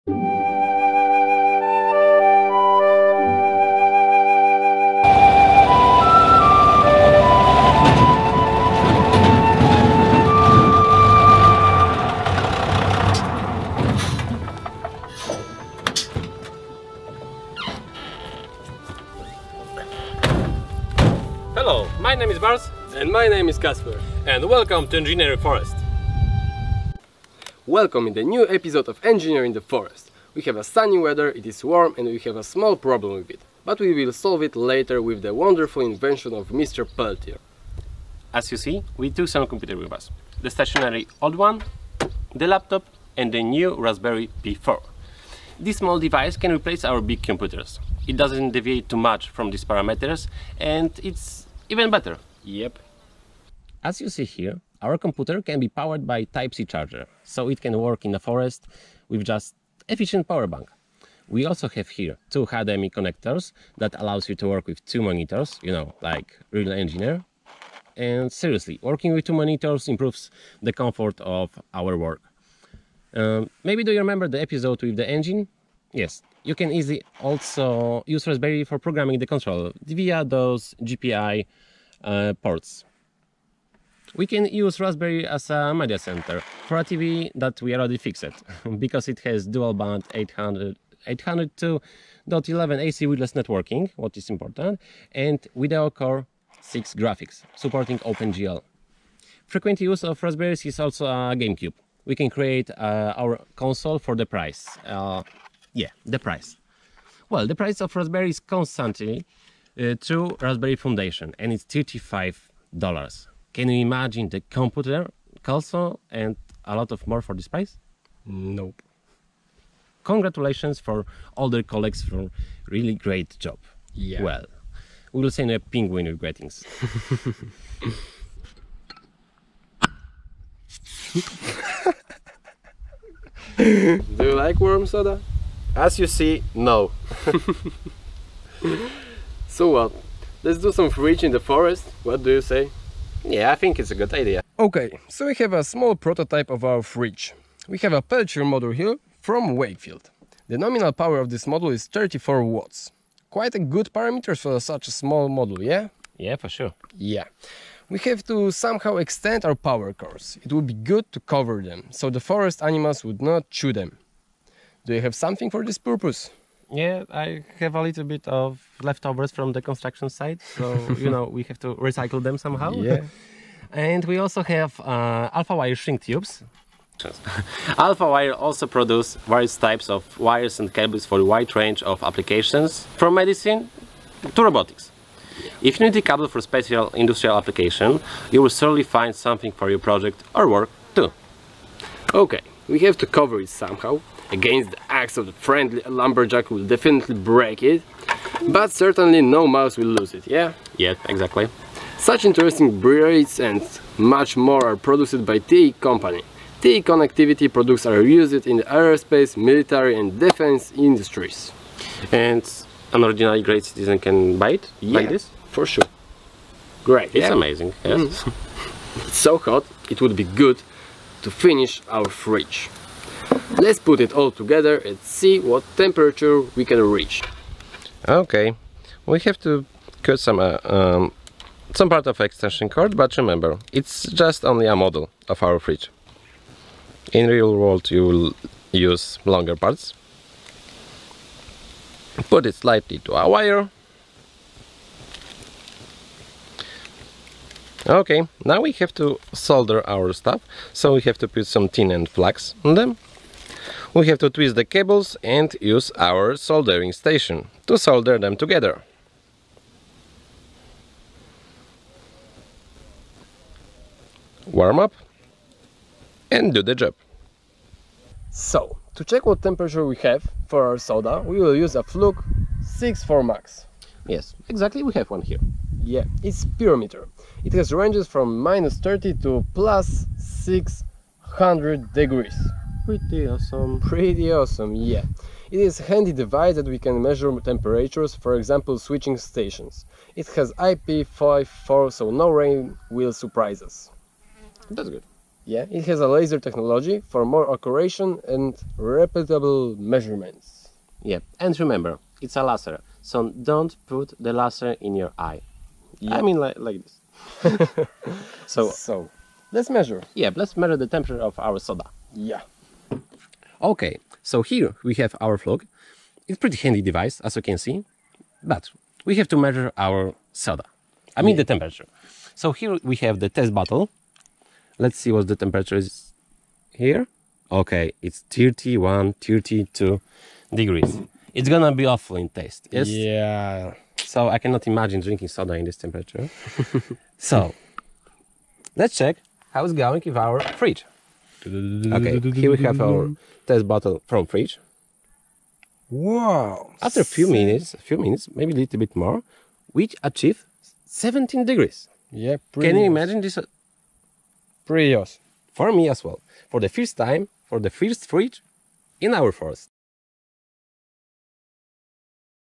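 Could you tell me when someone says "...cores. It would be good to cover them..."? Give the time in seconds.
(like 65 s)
159 s.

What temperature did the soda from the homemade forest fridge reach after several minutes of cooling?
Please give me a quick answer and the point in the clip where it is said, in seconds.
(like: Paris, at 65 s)
17 degrees, at 350 s.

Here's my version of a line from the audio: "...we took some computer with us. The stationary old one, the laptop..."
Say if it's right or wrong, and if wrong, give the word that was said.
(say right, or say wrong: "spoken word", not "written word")
right.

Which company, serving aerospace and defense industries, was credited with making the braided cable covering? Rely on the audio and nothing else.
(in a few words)
TE Connectivity.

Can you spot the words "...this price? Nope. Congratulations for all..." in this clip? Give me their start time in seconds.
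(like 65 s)
117 s.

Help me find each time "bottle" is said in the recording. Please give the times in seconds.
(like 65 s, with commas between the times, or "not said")
323 s, 343 s.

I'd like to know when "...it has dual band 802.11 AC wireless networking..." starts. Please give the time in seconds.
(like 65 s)
89 s.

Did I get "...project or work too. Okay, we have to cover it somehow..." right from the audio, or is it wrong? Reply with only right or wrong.
right.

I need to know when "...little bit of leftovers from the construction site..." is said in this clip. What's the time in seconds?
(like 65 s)
167 s.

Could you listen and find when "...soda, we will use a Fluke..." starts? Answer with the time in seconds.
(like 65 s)
270 s.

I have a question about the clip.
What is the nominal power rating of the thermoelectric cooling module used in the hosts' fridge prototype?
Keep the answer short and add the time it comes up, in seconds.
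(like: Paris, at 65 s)
34 watts, at 151 s.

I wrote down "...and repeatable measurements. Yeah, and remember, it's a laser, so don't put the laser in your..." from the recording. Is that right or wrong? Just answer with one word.
right.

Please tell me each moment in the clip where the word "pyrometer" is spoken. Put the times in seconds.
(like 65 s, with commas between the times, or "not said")
276 s.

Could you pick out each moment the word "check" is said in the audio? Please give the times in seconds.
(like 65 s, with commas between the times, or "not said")
269 s, 338 s.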